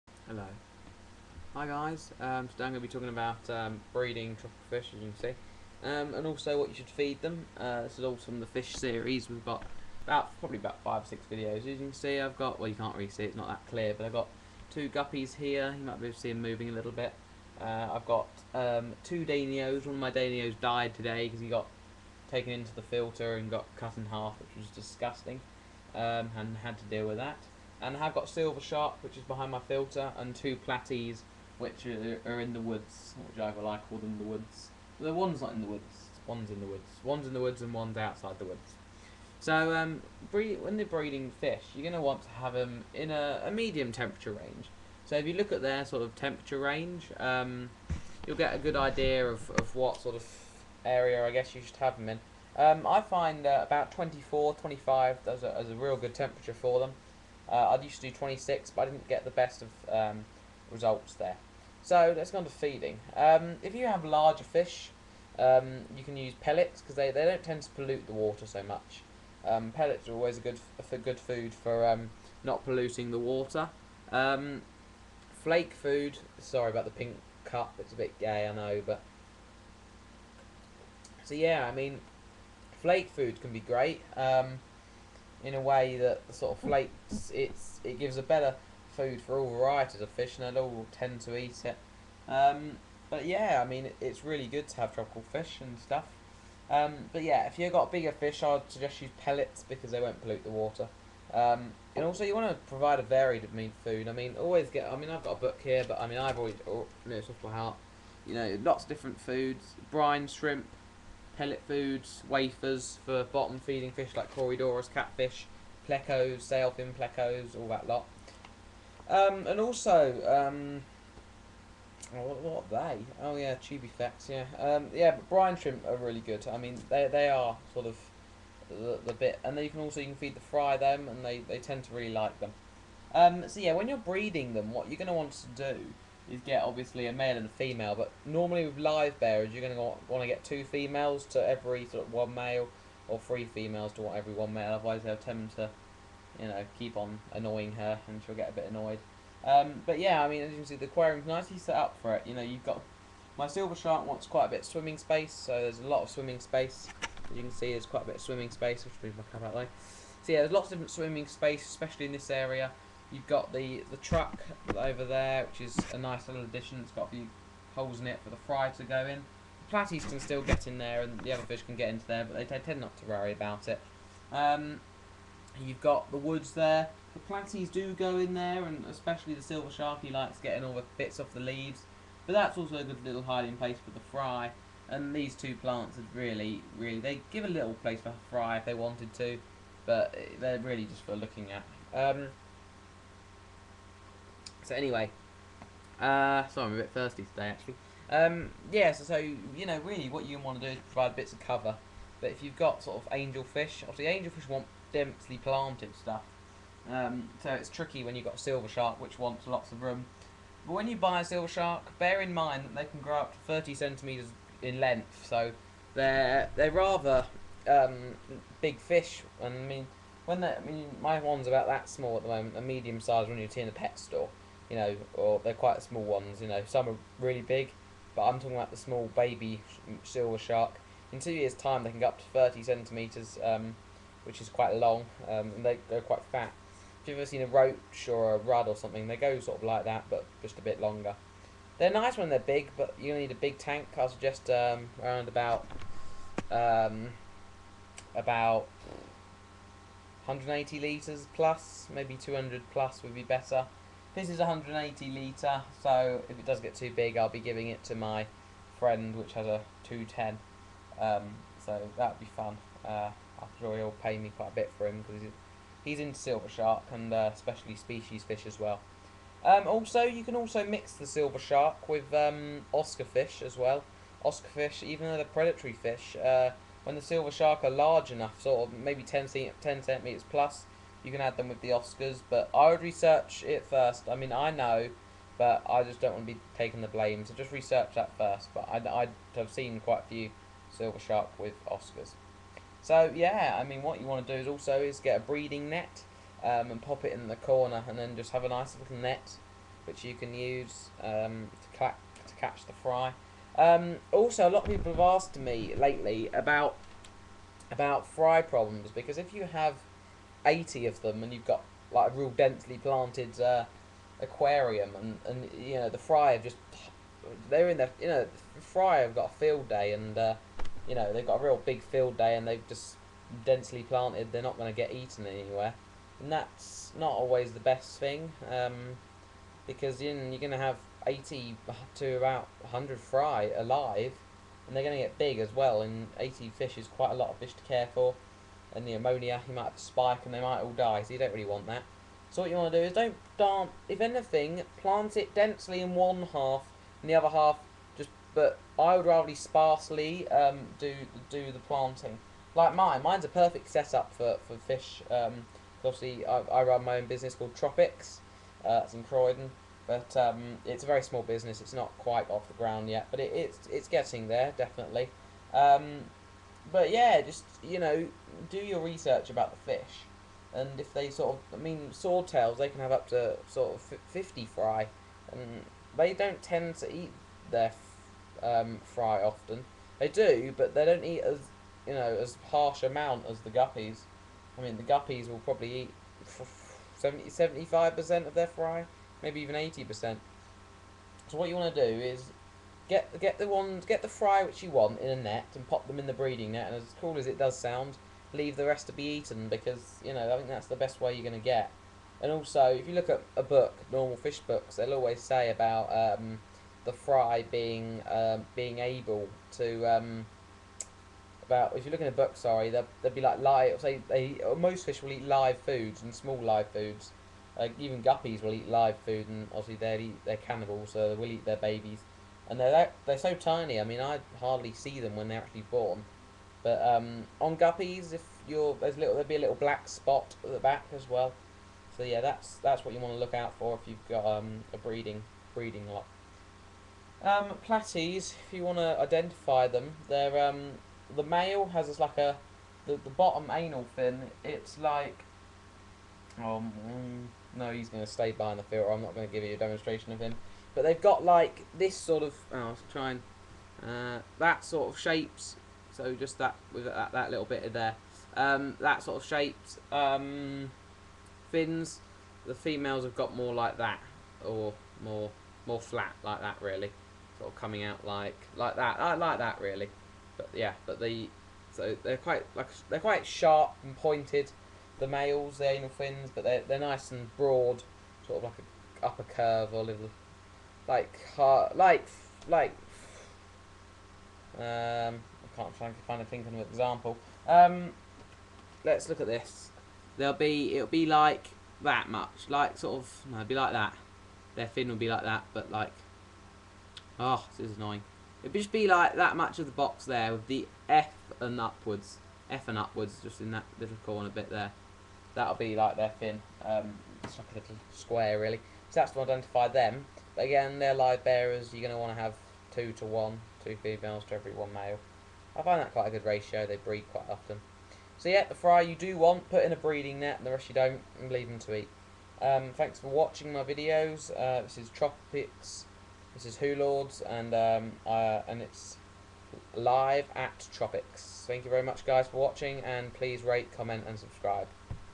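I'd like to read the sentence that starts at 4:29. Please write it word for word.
Um, also, you can also mix the silver shark with um, Oscar fish as well.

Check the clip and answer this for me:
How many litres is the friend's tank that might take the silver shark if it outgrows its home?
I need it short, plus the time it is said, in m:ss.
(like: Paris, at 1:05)
210, at 4:19.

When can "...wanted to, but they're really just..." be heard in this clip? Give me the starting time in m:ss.
3:08.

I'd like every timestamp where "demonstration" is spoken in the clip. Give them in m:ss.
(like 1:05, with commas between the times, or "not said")
7:29.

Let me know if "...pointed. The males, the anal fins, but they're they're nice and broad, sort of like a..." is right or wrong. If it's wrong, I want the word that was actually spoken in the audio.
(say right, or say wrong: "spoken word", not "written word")
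right.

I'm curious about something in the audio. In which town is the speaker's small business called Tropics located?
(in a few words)
Croydon.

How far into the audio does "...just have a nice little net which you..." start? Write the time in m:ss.
4:58.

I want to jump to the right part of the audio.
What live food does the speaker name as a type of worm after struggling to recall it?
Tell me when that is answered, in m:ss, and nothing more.
2:03.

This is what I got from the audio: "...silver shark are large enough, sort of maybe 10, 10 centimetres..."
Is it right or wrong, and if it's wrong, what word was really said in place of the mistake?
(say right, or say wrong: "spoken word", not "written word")
right.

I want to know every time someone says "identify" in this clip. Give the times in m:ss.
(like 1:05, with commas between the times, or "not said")
7:18, 8:29.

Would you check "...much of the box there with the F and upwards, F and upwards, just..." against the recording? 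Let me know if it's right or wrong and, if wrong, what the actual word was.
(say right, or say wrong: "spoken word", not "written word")
right.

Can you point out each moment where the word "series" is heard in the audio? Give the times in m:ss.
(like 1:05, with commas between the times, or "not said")
0:08.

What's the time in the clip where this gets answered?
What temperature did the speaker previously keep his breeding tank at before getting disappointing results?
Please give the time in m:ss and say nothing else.
0:57.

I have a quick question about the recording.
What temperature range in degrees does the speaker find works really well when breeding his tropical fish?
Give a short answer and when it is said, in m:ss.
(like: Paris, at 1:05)
24 to 25, at 0:53.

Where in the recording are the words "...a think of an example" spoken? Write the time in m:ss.
8:06.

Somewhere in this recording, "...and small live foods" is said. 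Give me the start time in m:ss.
6:56.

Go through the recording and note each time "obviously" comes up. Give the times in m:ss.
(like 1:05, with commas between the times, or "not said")
2:16, 3:23, 5:55, 6:59.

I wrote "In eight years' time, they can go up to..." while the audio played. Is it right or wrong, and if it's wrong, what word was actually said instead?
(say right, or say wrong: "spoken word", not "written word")
wrong: "two", not "eight".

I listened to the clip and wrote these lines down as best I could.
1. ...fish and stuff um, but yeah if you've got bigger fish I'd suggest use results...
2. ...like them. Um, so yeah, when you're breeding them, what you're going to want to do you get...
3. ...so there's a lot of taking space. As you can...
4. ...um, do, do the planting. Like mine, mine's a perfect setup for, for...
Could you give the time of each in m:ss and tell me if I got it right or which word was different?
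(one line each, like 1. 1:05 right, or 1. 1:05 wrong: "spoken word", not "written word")
1. 1:35 wrong: "pellets", not "results"
2. 2:12 right
3. 2:35 wrong: "swimming", not "taking"
4. 5:50 right.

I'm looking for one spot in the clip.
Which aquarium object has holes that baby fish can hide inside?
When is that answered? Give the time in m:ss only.
2:43.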